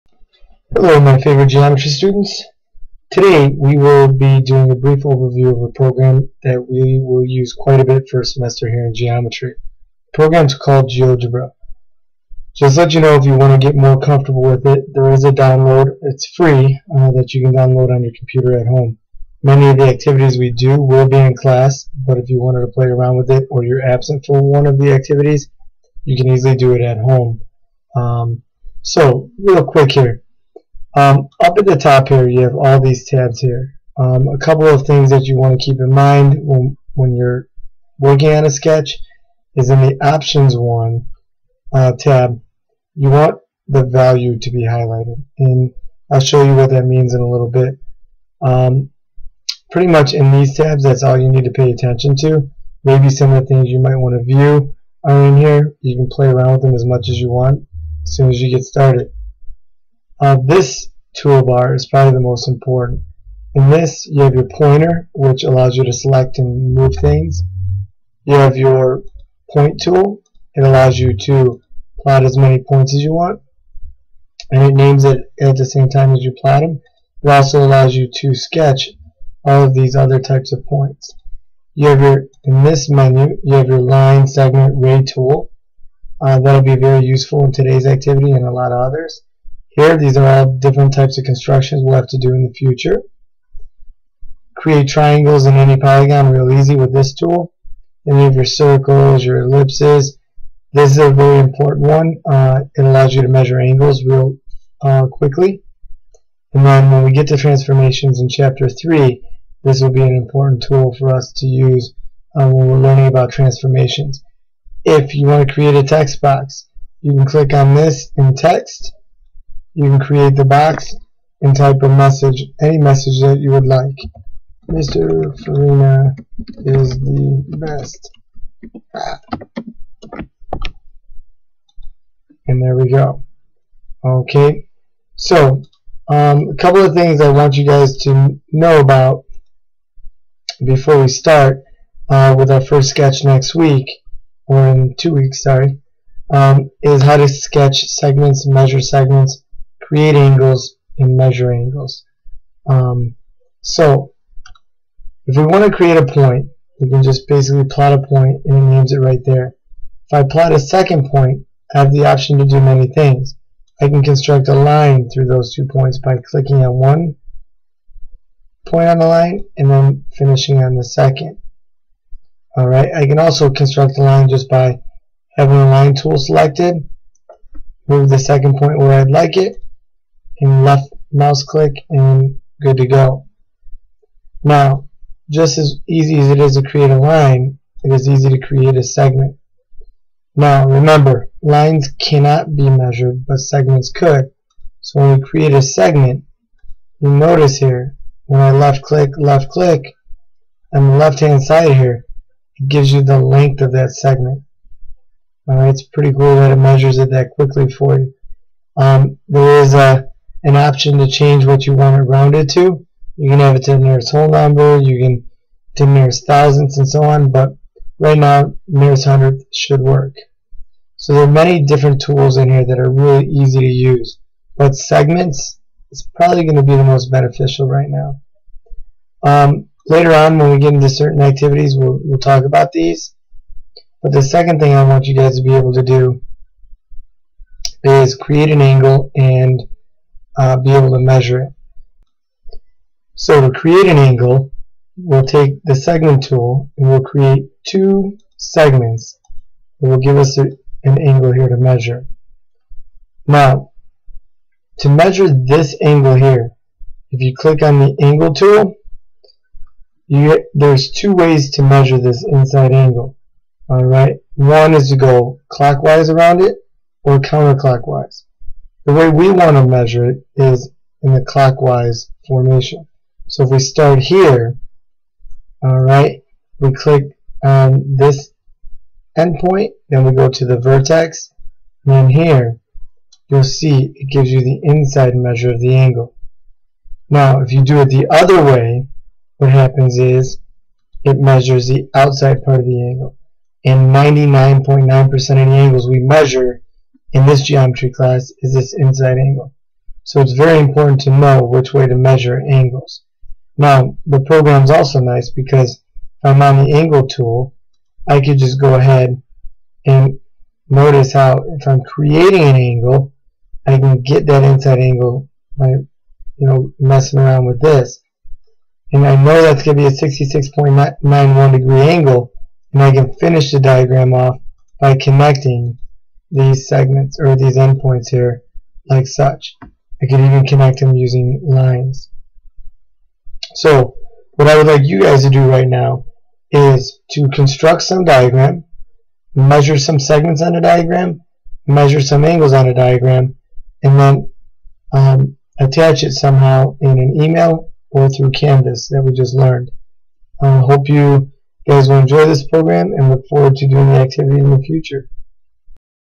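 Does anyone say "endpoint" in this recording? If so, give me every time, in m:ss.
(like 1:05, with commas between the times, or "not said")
4:39, 5:27.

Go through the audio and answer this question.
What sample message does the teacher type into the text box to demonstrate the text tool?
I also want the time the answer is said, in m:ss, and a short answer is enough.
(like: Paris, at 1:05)
Mr. Farina is the best, at 2:04.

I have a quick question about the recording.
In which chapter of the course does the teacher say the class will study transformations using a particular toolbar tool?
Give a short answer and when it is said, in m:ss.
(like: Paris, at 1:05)
Chapter 3, at 1:48.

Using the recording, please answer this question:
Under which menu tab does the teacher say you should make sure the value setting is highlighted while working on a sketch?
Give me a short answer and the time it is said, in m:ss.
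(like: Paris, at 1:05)
Options, at 0:40.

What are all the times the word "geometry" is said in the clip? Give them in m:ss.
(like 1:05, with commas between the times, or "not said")
0:01, 0:08, 4:57.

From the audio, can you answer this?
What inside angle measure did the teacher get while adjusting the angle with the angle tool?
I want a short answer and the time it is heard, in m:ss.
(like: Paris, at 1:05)
66.91 degrees, at 5:20.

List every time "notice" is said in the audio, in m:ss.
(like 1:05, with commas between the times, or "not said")
3:17, 5:10.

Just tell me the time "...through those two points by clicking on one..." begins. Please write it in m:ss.
2:45.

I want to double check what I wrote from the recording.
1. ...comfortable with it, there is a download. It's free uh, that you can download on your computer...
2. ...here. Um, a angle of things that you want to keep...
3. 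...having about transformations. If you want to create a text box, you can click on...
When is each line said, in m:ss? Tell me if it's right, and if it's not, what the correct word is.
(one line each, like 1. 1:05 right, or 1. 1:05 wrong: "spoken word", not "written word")
1. 0:13 right
2. 0:33 wrong: "couple", not "angle"
3. 1:52 wrong: "learning", not "having".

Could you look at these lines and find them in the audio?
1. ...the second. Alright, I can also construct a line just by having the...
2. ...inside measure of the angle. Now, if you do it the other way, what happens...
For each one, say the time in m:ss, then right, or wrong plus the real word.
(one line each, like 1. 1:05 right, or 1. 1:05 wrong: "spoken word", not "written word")
1. 2:50 right
2. 4:44 right.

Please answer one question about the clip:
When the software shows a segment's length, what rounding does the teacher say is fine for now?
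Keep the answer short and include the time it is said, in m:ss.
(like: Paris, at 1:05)
Nearest hundredth, at 3:38.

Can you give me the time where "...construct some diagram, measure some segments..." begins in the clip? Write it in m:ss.
5:37.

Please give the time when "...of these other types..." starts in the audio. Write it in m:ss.
1:19.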